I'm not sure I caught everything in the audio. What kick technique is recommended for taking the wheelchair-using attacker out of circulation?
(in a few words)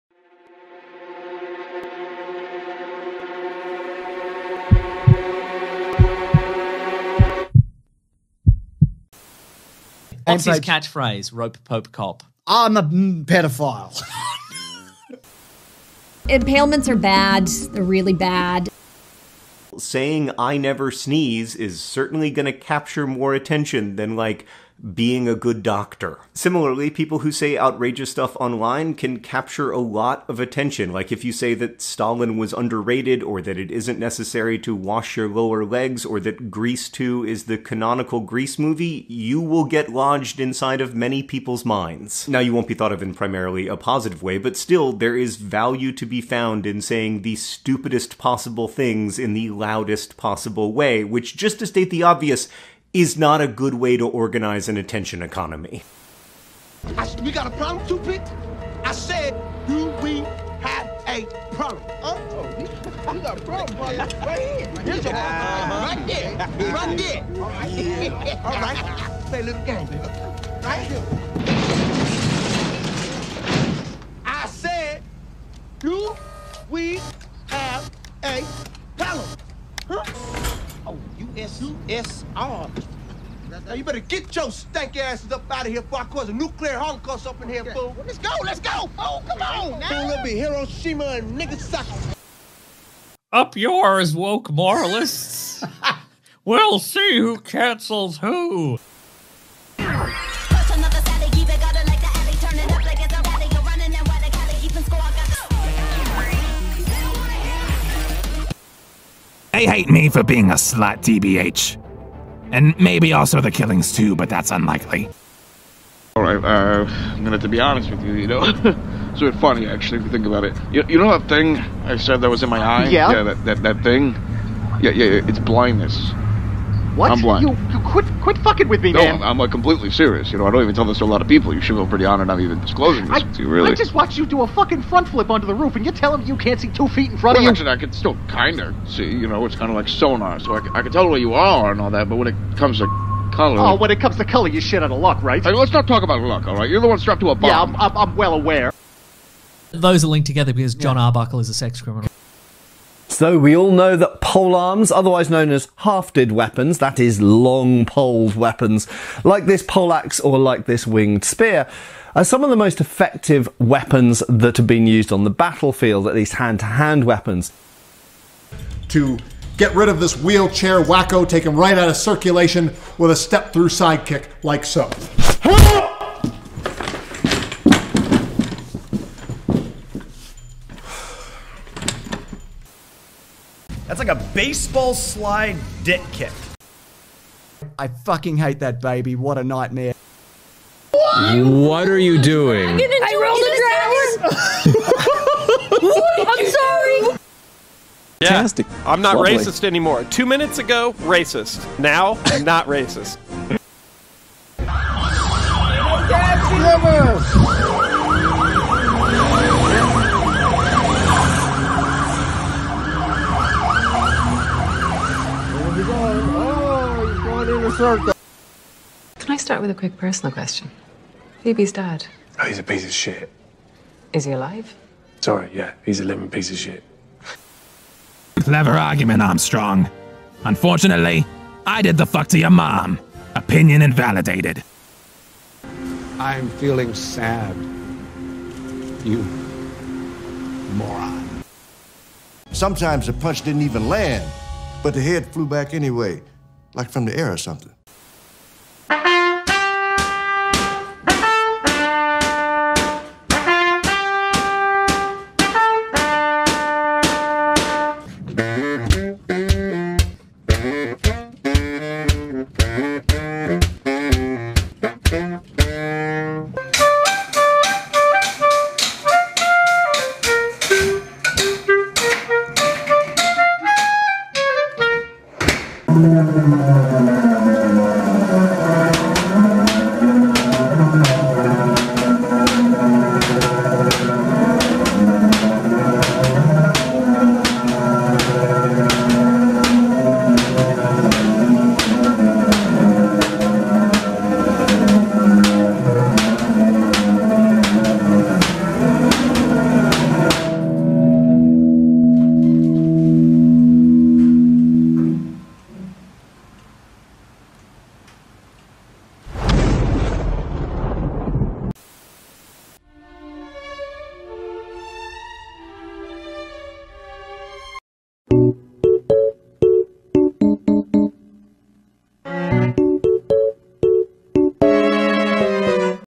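step through sidekick.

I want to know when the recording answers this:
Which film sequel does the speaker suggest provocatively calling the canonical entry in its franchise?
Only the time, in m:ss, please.
0:36.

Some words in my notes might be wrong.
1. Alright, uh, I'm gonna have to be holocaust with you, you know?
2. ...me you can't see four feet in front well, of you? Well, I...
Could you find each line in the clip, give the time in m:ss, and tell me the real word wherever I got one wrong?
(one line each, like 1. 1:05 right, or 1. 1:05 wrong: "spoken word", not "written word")
1. 1:56 wrong: "honest", not "holocaust"
2. 2:16 wrong: "two", not "four".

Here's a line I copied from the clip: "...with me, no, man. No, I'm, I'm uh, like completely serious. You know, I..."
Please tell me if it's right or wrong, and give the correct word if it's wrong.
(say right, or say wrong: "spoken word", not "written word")
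right.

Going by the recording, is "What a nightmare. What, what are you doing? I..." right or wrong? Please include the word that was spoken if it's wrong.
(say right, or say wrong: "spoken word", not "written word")
right.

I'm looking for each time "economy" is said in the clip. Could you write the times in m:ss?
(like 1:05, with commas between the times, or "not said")
0:55.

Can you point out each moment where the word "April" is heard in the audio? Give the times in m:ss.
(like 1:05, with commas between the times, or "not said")
not said.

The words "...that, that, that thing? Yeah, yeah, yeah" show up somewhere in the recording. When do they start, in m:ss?
2:03.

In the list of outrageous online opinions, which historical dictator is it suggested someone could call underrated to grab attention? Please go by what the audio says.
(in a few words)
Stalin.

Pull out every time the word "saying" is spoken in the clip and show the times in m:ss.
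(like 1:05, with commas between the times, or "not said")
0:19, 0:46.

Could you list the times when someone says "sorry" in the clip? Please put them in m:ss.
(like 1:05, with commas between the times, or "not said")
3:16, 3:45.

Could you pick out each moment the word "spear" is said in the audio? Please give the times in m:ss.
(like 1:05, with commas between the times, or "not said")
2:41.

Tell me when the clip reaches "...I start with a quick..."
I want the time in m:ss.
3:39.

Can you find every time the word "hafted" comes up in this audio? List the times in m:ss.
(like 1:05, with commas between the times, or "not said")
2:35.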